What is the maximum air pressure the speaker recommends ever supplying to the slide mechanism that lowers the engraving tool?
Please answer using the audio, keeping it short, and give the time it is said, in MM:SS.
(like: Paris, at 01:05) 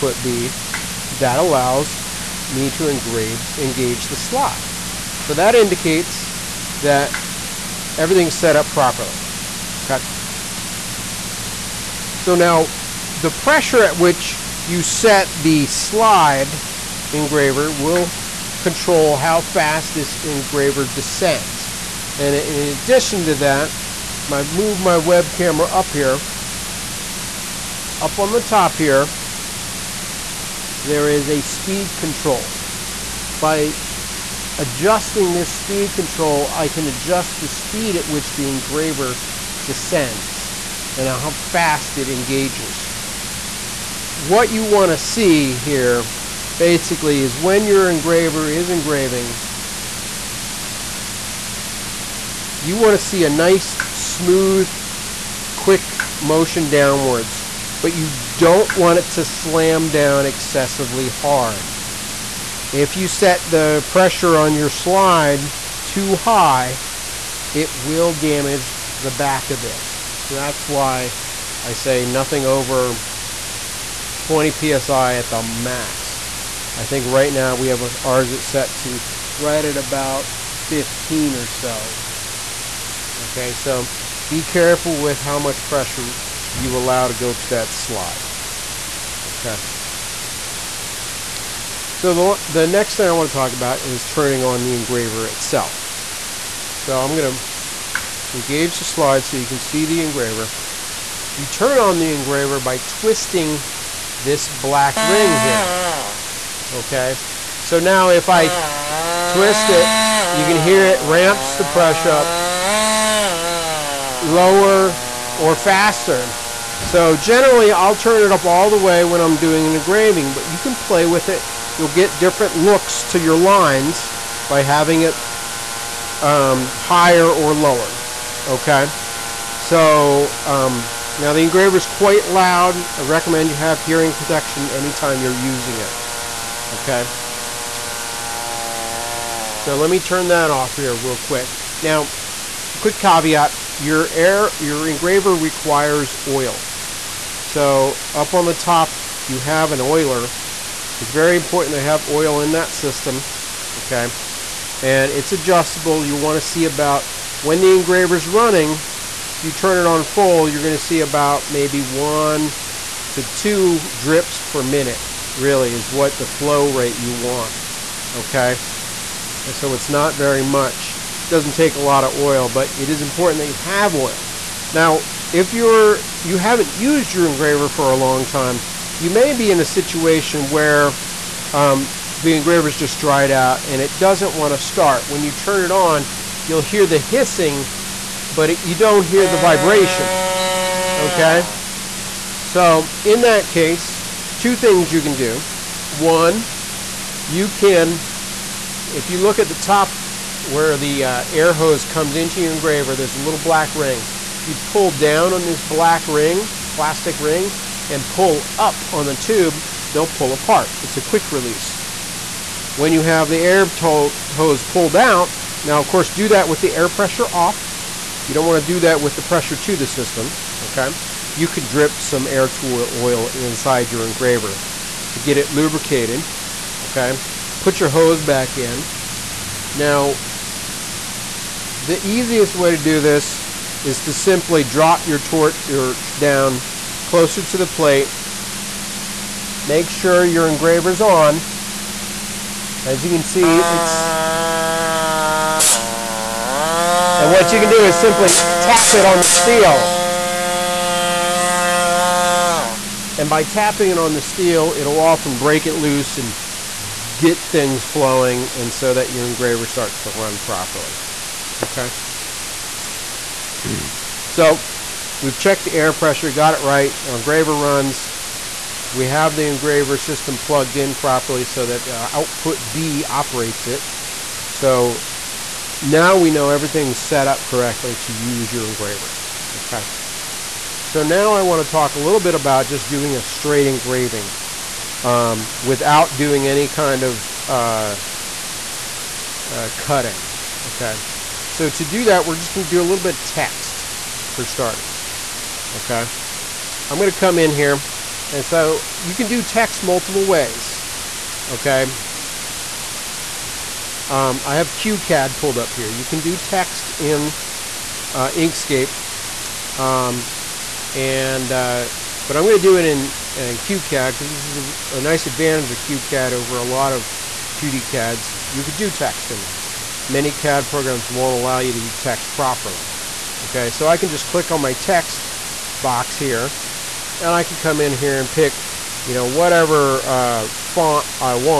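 20 psi, at 01:14.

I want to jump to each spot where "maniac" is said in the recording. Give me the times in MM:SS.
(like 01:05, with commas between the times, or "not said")
not said.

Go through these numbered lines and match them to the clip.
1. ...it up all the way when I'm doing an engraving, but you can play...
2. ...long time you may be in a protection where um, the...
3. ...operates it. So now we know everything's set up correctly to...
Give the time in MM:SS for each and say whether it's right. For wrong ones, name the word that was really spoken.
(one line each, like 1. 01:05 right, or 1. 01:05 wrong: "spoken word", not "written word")
1. 01:58 right
2. 02:57 wrong: "situation", not "protection"
3. 04:33 right.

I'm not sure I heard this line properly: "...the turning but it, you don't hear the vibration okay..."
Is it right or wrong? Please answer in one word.
wrong.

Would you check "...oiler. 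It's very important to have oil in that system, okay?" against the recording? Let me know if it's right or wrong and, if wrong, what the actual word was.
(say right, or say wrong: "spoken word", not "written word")
right.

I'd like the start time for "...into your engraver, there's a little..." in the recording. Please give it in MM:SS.
03:22.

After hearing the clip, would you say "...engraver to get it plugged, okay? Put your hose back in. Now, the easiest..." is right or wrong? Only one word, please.
wrong.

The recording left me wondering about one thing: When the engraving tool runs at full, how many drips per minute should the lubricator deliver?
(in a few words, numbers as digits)
1 to 2.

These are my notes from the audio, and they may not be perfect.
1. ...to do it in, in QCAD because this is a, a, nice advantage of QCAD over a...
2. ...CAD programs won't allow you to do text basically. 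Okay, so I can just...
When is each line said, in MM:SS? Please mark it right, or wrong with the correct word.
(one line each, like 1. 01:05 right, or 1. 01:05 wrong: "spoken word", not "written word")
1. 05:12 right
2. 05:20 wrong: "properly", not "basically".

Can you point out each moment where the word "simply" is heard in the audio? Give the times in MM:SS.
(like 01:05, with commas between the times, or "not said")
03:54, 04:07.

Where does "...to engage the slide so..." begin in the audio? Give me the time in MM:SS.
01:37.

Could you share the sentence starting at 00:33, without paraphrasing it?
By adjusting this speed control, I can adjust the speed at which the engraver descends and how fast it engages.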